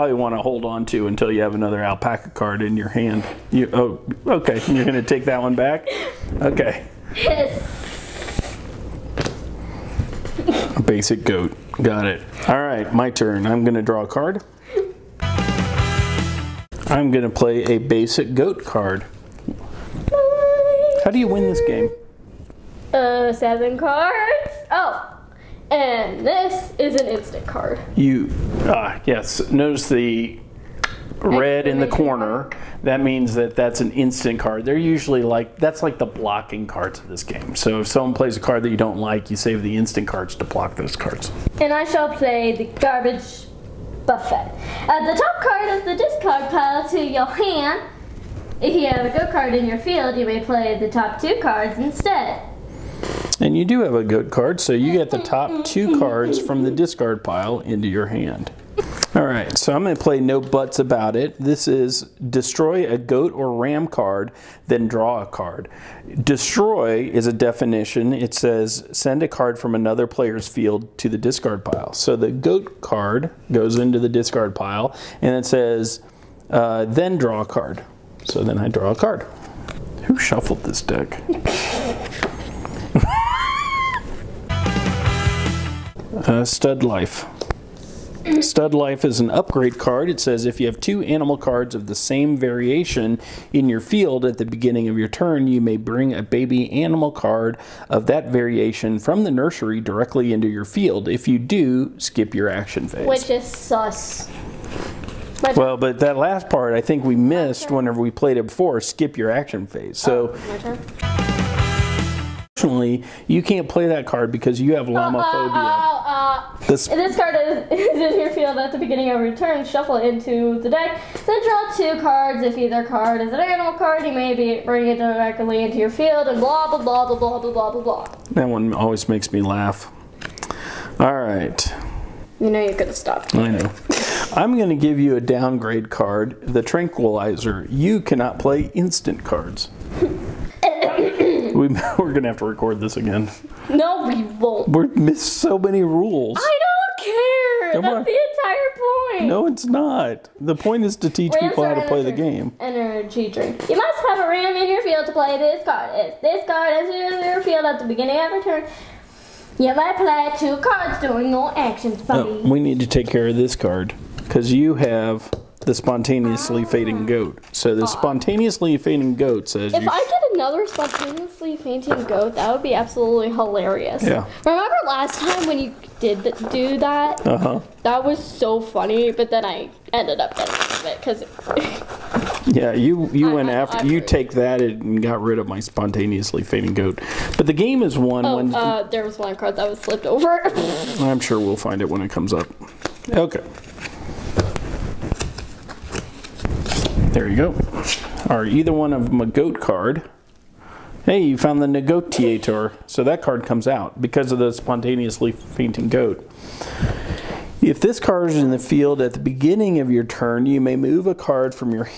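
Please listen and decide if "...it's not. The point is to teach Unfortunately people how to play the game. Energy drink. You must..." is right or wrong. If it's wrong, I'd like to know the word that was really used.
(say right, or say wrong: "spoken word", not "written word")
wrong: "Rams", not "Unfortunately".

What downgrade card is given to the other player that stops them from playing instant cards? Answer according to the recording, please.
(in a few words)
The Tranquilizer.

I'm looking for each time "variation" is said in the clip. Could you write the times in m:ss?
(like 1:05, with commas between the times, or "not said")
1:32, 1:38.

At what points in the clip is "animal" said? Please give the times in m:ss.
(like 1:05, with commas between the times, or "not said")
1:31, 1:36, 2:03.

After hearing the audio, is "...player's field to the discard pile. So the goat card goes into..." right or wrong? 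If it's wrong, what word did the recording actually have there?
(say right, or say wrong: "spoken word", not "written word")
right.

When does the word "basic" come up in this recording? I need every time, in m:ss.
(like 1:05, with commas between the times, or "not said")
0:10, 0:17.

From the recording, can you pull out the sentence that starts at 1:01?
This is destroy a goat or ram card, then draw a card.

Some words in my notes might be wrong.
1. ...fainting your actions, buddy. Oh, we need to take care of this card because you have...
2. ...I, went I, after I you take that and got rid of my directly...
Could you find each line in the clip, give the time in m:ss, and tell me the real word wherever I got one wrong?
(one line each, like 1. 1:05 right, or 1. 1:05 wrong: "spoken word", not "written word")
1. 2:40 wrong: "during", not "fainting"
2. 3:03 wrong: "spontaneously", not "directly".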